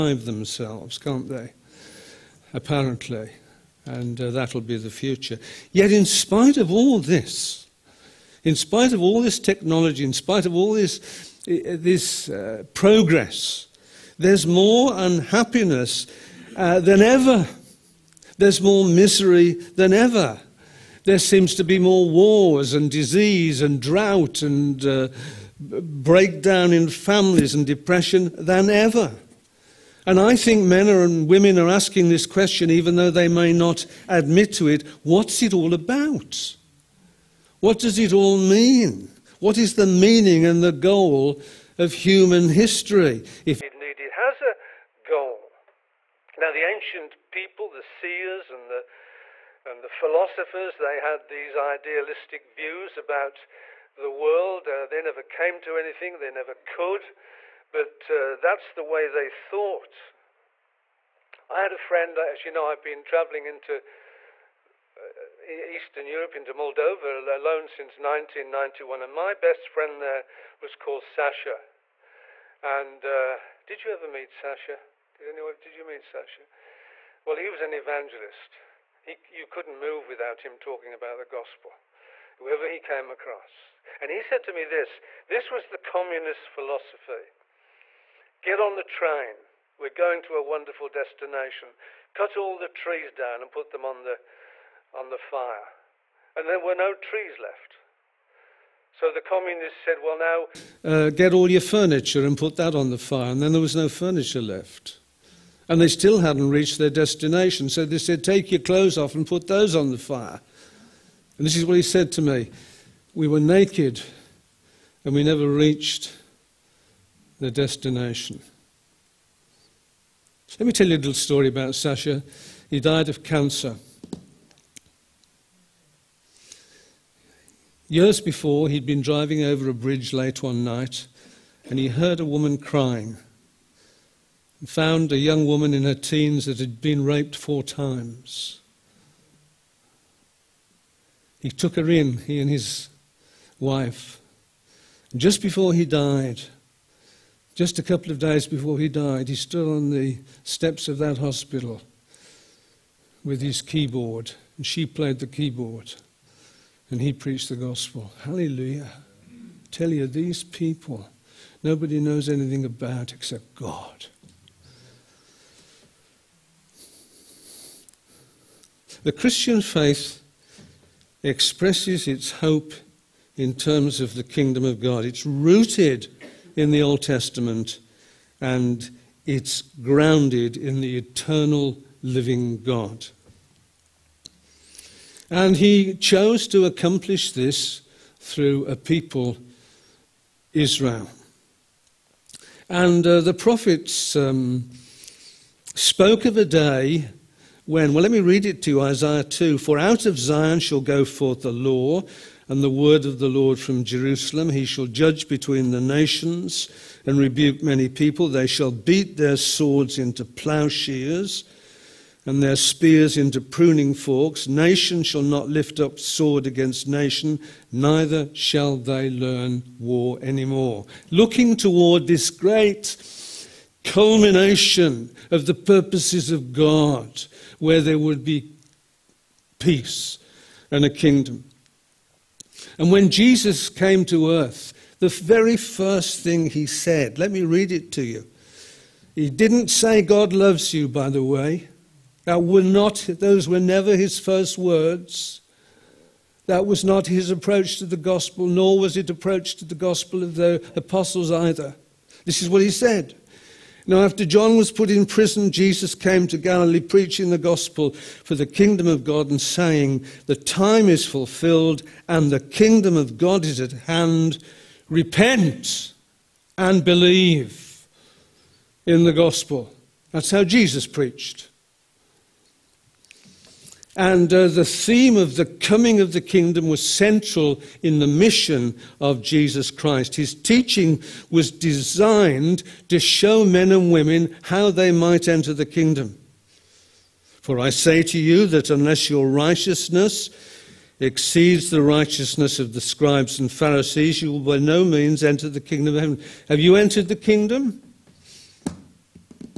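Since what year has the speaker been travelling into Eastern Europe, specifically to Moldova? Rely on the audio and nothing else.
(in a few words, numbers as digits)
1991.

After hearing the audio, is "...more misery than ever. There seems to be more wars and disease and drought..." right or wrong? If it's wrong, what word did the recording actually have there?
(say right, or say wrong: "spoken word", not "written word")
right.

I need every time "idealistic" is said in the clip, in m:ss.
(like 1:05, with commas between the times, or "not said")
0:51.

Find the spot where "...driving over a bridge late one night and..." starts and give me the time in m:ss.
2:09.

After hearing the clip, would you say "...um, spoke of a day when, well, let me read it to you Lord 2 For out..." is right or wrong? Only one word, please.
wrong.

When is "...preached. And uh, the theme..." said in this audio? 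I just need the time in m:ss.
4:30.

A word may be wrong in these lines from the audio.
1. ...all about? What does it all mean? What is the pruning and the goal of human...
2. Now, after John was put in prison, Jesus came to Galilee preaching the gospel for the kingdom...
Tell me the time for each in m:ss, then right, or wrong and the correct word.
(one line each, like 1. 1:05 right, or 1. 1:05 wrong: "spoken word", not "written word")
1. 0:35 wrong: "meaning", not "pruning"
2. 4:13 right.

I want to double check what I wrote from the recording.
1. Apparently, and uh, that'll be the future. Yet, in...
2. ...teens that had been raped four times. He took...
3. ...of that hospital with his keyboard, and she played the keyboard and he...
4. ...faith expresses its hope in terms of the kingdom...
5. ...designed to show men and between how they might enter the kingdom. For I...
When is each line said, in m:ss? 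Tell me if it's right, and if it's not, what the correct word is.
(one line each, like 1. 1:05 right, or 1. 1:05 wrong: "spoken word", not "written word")
1. 0:02 right
2. 2:15 right
3. 2:30 right
4. 2:49 right
5. 4:41 wrong: "women", not "between".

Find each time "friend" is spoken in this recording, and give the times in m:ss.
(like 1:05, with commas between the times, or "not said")
1:01, 1:09.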